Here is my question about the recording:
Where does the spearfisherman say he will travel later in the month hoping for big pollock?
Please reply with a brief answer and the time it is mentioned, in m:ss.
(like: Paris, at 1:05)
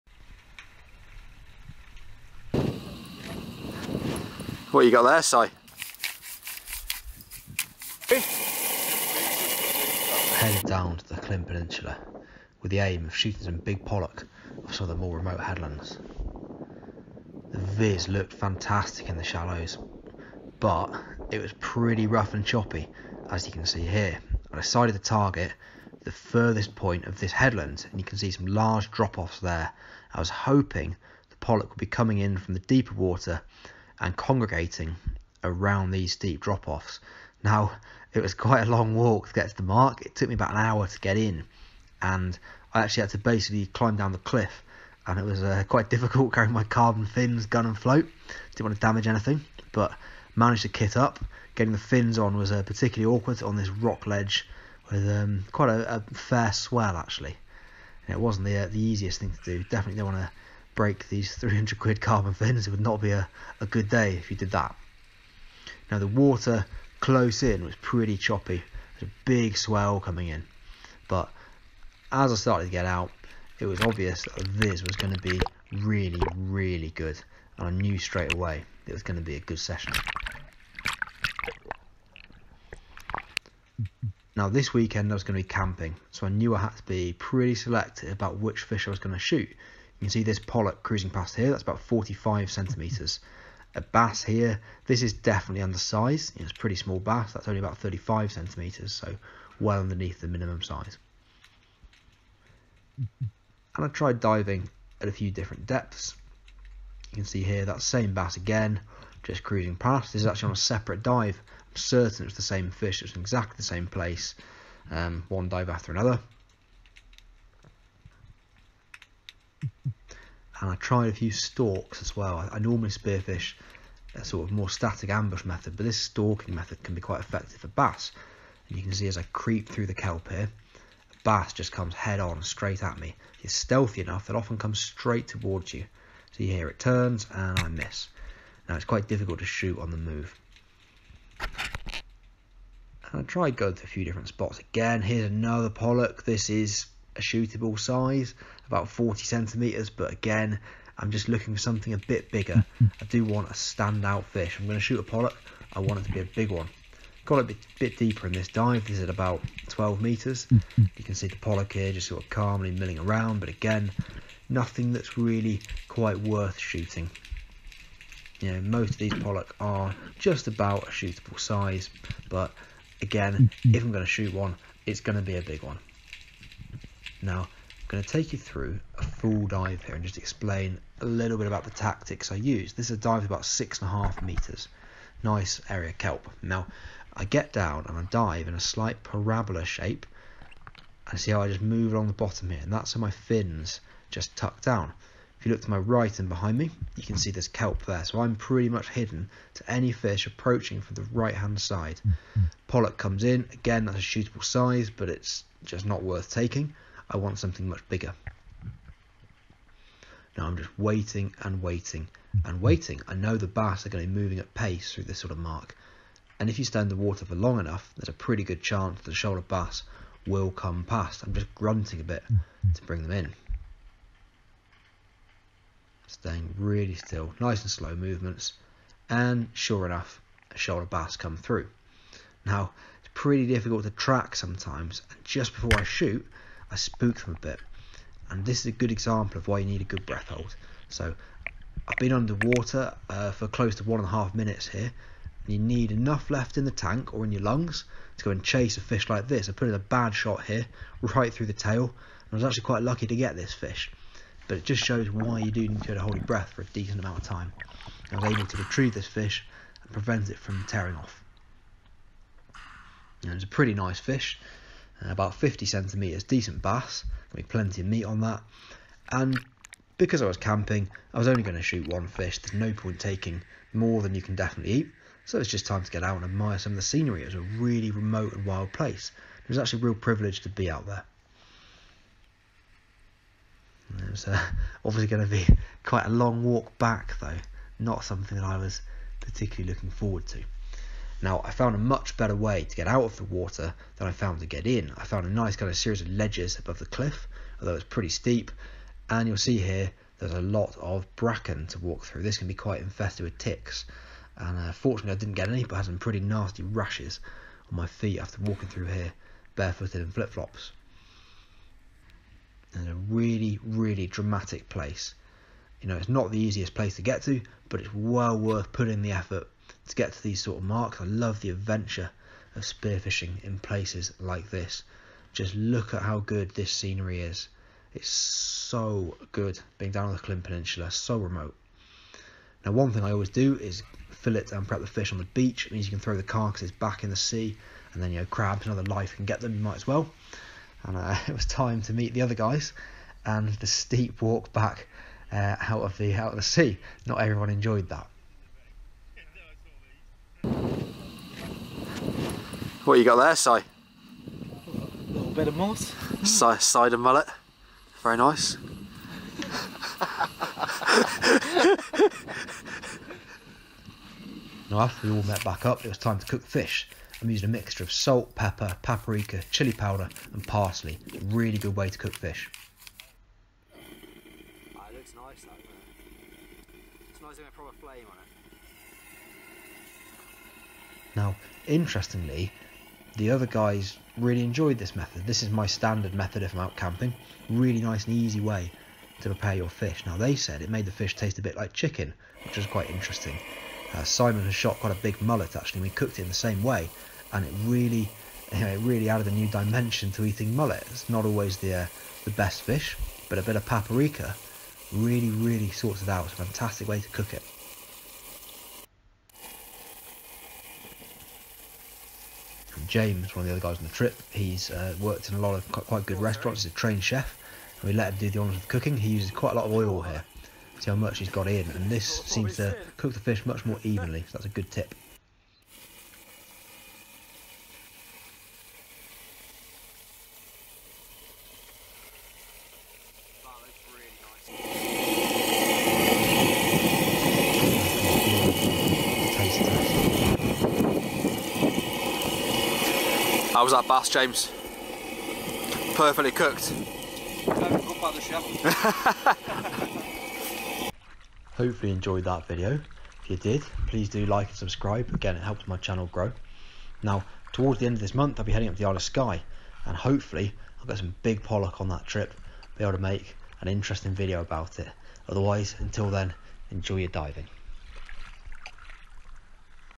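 Isle of Skye, at 7:38.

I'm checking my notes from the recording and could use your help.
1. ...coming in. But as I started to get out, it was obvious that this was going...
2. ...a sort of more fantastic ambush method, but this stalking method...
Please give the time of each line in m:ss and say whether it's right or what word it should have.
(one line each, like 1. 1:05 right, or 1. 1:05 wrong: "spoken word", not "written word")
1. 1:09 right
2. 2:04 wrong: "static", not "fantastic".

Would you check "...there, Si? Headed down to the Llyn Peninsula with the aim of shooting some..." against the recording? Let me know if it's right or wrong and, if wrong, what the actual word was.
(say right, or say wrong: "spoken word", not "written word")
right.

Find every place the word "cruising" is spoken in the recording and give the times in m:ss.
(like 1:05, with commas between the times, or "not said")
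1:30, 1:49.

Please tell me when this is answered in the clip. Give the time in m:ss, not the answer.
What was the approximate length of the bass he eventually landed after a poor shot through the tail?
4:25.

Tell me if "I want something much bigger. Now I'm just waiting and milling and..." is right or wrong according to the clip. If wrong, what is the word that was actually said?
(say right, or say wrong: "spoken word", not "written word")
wrong: "waiting", not "milling".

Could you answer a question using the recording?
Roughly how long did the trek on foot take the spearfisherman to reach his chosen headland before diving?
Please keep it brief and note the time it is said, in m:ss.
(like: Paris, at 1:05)
about an hour, at 0:40.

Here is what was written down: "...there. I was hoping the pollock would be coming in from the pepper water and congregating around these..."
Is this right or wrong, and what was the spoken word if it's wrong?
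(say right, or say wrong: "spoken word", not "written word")
wrong: "deeper", not "pepper".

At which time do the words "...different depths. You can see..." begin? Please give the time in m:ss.
1:45.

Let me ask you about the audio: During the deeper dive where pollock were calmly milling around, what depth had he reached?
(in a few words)
12 meters.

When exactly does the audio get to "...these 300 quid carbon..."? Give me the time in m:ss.
1:01.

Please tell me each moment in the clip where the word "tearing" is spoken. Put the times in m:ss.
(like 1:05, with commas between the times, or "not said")
4:20.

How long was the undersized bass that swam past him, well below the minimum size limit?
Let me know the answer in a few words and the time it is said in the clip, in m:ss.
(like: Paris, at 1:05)
35 centimetres, at 1:37.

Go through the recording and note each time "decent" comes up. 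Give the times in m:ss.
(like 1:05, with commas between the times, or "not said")
4:16, 4:26.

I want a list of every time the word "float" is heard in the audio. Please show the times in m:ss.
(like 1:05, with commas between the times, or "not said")
0:47.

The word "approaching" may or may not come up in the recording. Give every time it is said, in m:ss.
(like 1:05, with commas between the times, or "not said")
3:20.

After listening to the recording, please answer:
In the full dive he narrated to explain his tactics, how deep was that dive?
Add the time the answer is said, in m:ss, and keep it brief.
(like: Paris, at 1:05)
six and a half meters, at 3:03.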